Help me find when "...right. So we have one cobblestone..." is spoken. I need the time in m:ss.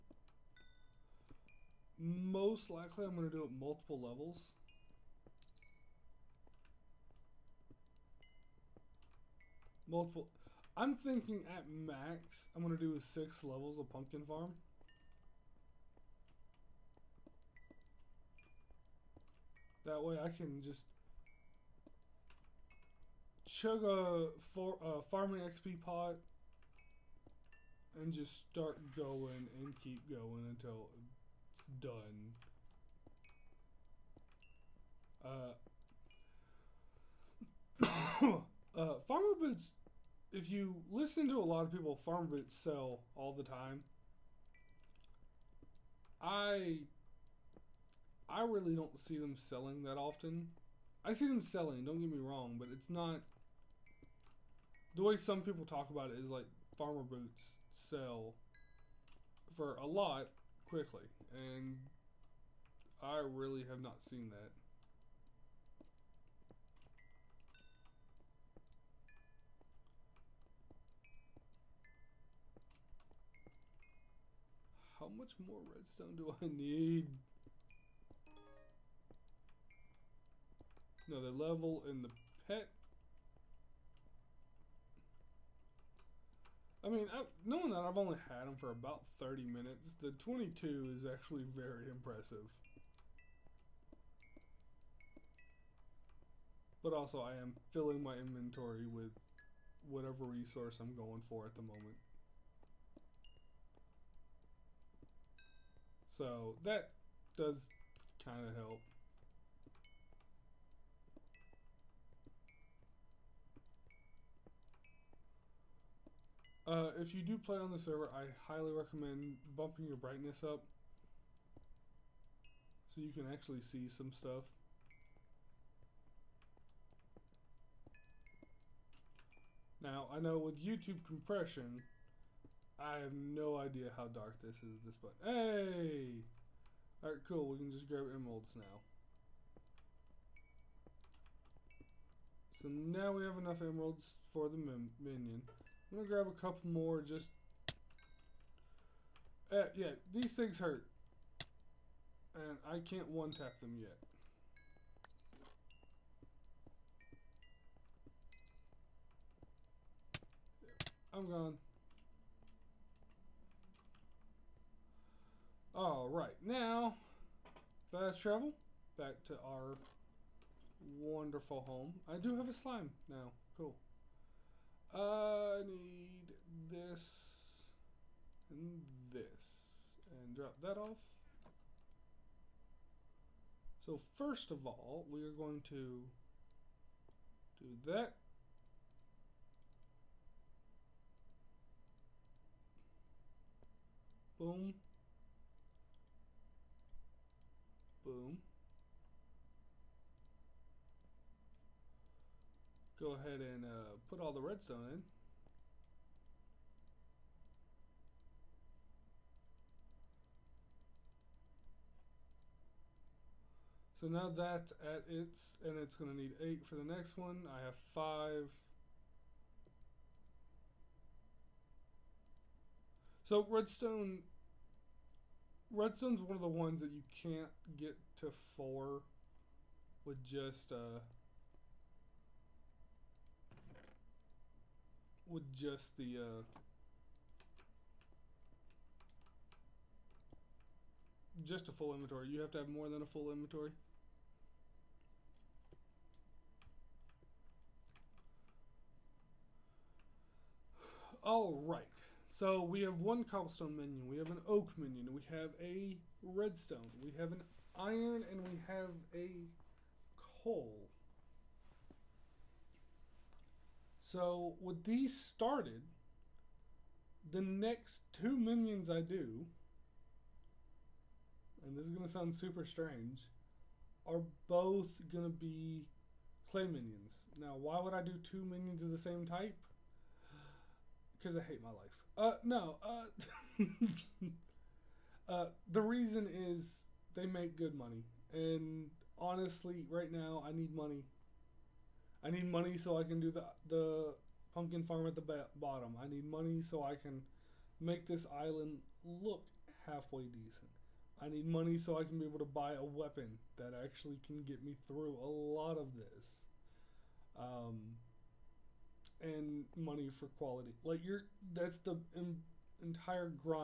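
4:11.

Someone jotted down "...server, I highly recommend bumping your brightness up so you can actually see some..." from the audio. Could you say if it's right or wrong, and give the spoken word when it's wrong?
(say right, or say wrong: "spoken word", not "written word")
right.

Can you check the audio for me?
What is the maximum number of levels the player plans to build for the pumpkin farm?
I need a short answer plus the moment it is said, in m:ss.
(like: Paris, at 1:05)
6, at 0:13.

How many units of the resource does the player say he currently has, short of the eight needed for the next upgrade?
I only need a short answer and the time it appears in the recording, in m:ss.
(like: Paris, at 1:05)
5, at 3:37.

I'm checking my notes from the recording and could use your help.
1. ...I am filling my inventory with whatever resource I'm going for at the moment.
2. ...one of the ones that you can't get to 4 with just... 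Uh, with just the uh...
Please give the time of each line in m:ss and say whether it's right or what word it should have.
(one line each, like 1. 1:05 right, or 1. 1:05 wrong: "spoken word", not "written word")
1. 1:37 right
2. 3:46 right.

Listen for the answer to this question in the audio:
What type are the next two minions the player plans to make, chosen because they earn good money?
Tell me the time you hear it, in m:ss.
4:36.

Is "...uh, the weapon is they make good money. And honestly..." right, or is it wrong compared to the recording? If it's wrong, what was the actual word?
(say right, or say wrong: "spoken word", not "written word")
wrong: "reason", not "weapon".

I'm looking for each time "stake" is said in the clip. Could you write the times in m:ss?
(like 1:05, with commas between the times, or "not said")
not said.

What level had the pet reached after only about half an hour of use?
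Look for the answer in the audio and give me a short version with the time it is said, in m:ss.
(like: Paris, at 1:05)
22, at 1:30.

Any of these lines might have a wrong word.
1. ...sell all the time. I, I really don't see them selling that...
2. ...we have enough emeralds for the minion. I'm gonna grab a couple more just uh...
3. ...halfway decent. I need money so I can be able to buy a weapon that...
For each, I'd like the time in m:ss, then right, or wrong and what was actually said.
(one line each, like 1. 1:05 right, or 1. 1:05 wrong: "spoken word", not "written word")
1. 0:42 right
2. 2:23 right
3. 4:59 right.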